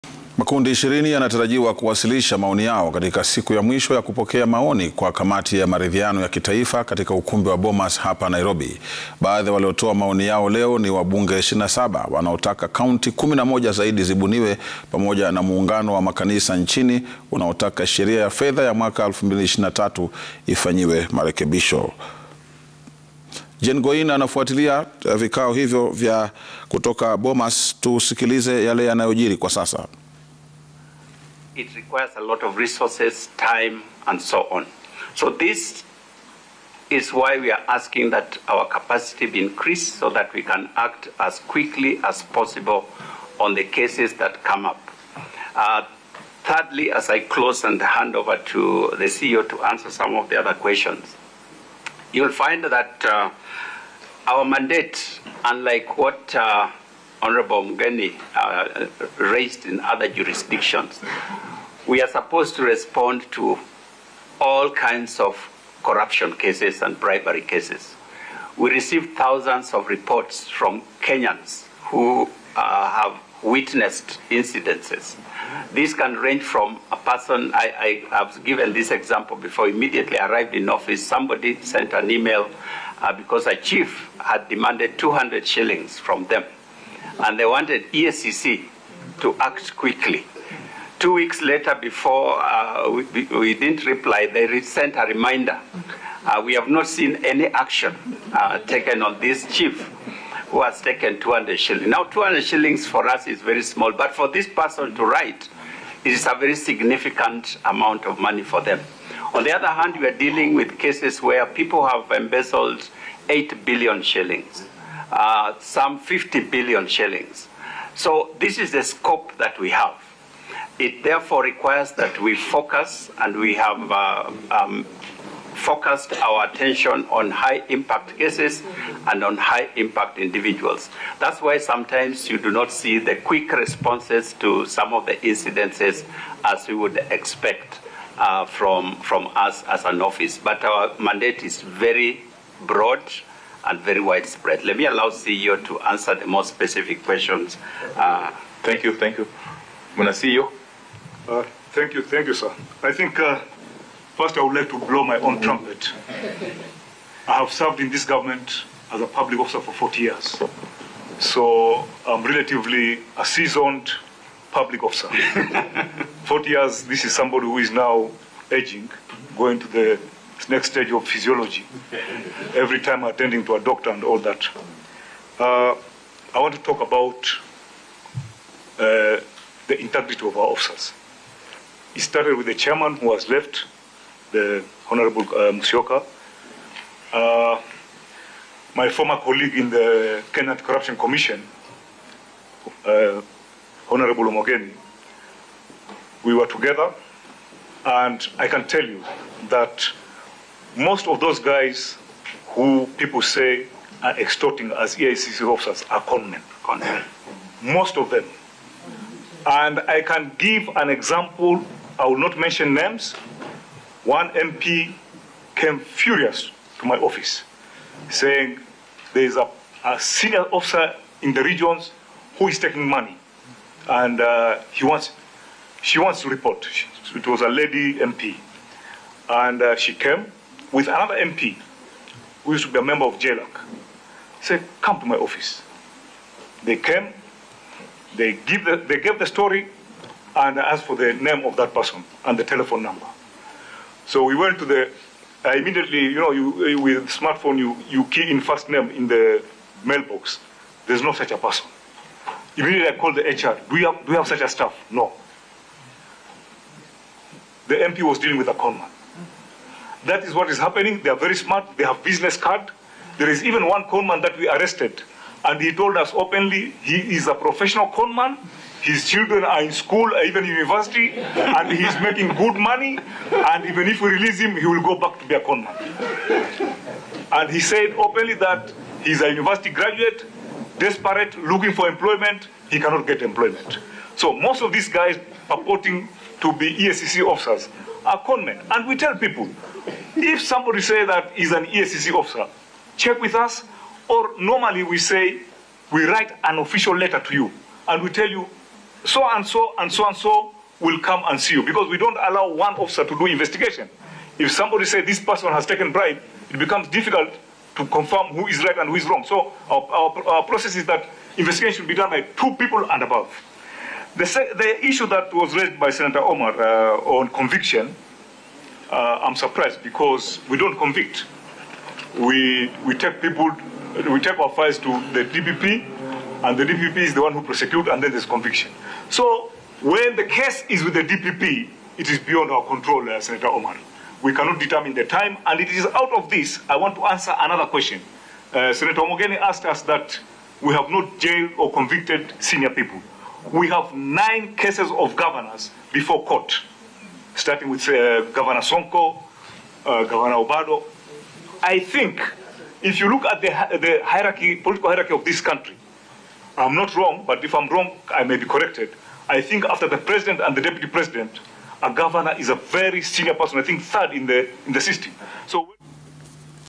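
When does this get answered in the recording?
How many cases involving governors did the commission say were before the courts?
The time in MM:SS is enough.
05:43.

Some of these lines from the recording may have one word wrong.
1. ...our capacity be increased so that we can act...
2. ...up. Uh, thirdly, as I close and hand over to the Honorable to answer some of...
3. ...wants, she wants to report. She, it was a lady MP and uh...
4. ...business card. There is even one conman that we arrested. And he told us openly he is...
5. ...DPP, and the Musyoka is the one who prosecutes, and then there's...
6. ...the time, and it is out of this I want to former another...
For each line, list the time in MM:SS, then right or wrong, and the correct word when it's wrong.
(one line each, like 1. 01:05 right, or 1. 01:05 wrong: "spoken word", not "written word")
1. 00:38 right
2. 00:44 wrong: "CEO", not "Honorable"
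3. 03:44 right
4. 04:22 right
5. 05:25 wrong: "DPP", not "Musyoka"
6. 05:34 wrong: "answer", not "former".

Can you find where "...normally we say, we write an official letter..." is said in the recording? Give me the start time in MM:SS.
04:54.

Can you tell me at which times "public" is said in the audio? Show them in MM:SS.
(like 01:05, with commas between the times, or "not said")
02:39, 02:44.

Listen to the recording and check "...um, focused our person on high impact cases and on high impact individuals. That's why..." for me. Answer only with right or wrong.
wrong.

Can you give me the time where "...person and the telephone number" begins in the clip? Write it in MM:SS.
04:01.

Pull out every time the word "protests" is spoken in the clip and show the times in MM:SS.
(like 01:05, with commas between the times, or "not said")
not said.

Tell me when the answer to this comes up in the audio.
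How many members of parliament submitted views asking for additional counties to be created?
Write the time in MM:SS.
00:11.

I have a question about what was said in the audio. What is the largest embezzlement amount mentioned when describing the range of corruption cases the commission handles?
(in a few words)
50 billion shillings.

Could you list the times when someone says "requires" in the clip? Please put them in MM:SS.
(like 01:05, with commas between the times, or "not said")
00:31, 02:01.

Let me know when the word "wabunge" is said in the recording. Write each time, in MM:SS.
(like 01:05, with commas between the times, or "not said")
00:10.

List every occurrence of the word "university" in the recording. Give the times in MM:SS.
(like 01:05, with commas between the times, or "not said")
04:30, 04:39.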